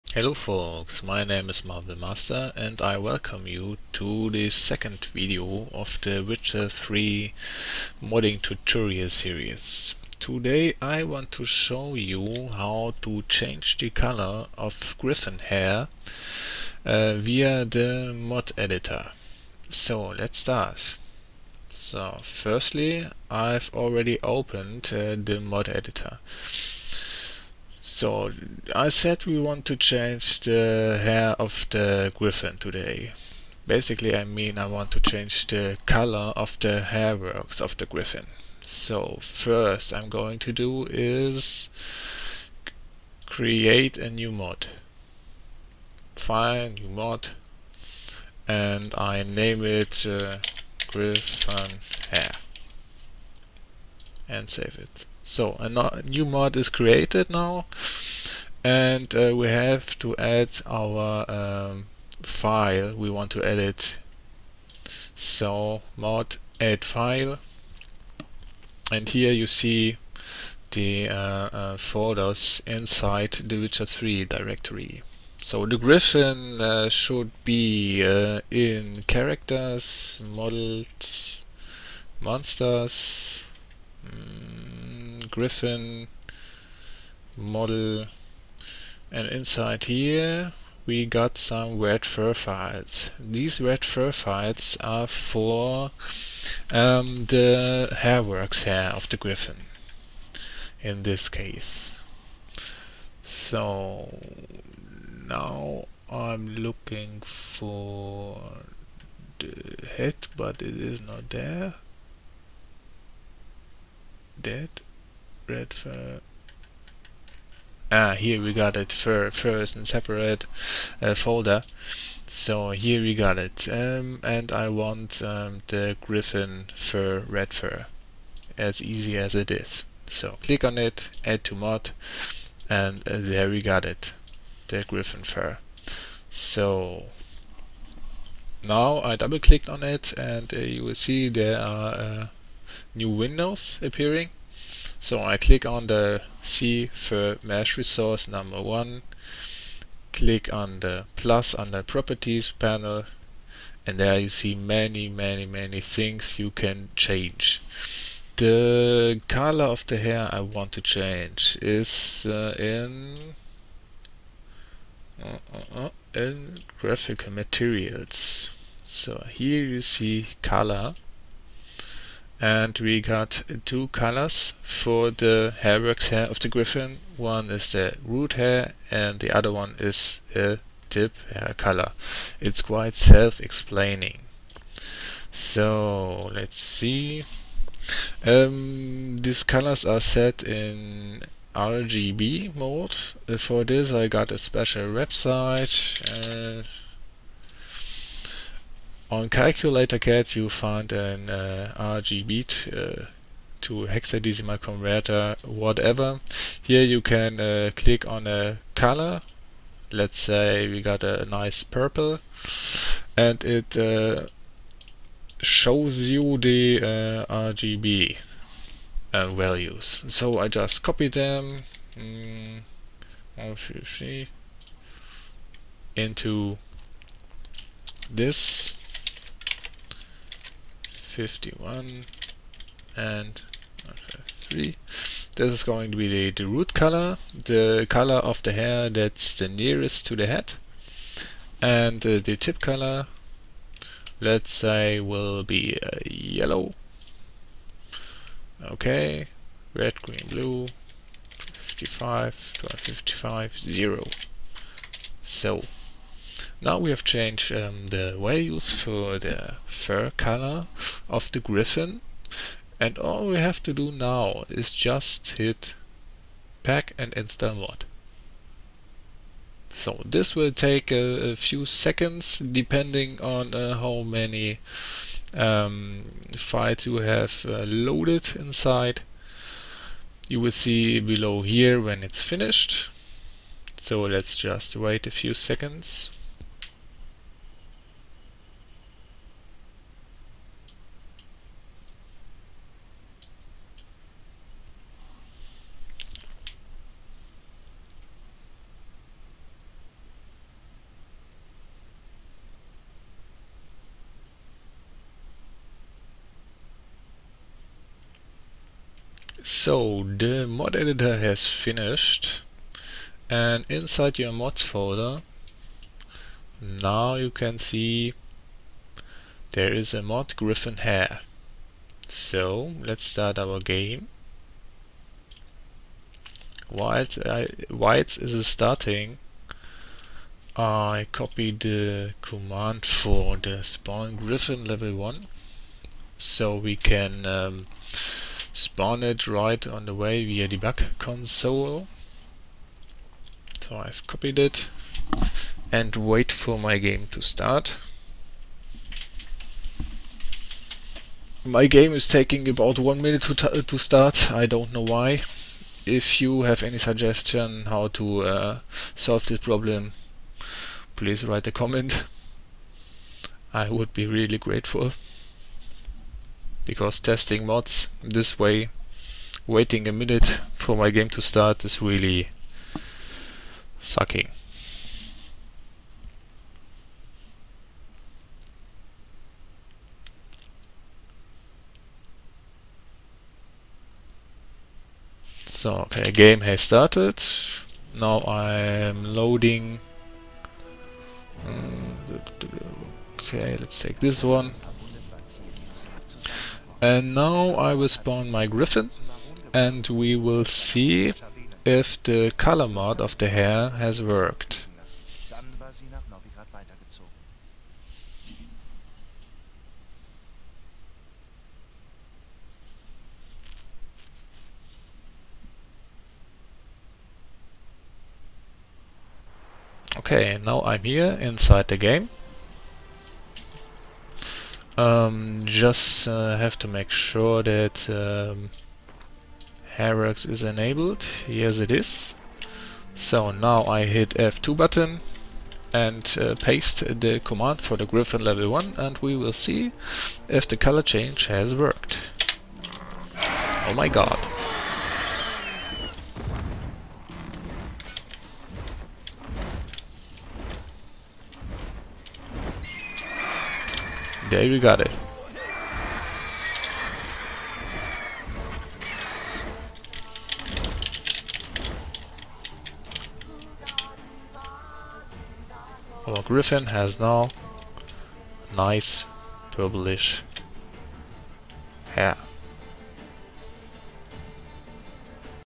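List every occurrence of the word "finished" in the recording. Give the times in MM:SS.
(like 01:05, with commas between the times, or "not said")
04:42, 05:11.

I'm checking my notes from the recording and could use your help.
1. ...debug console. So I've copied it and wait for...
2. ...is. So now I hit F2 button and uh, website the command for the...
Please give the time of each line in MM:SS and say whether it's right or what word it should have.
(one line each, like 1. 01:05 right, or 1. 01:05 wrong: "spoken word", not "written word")
1. 05:40 right
2. 07:11 wrong: "paste", not "website".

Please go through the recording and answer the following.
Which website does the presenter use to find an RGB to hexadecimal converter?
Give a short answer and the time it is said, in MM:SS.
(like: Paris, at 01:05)
calculator cat, at 03:19.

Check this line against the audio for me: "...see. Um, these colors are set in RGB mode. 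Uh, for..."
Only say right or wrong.
right.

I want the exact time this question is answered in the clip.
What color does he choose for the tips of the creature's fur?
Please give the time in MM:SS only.
04:06.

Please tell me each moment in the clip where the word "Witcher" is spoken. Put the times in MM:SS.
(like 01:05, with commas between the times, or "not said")
00:06, 01:13.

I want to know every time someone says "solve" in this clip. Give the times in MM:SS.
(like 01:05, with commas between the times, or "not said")
05:58.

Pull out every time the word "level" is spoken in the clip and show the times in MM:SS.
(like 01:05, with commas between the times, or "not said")
05:34, 07:18.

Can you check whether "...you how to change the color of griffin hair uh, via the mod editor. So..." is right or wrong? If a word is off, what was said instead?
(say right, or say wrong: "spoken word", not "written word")
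right.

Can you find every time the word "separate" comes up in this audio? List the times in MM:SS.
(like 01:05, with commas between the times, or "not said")
01:55, 01:59.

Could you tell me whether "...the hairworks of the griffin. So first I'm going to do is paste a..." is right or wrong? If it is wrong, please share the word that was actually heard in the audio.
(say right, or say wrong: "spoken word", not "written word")
wrong: "create", not "paste".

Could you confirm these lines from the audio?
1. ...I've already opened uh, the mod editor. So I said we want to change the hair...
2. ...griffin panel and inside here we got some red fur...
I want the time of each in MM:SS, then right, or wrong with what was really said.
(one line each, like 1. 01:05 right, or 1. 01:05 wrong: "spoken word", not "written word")
1. 00:23 right
2. 01:25 wrong: "model", not "panel".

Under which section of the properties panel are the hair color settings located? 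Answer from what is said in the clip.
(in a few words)
graphical materials.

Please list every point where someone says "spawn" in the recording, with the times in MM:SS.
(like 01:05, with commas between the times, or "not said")
05:33, 05:38, 06:37.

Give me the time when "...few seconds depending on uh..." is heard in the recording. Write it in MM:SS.
04:31.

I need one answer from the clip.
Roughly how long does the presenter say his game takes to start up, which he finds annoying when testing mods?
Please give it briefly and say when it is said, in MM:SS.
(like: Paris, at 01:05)
about one minute, at 05:52.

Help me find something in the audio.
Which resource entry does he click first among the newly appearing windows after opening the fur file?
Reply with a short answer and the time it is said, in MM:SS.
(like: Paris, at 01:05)
CFurMeshResource, at 02:26.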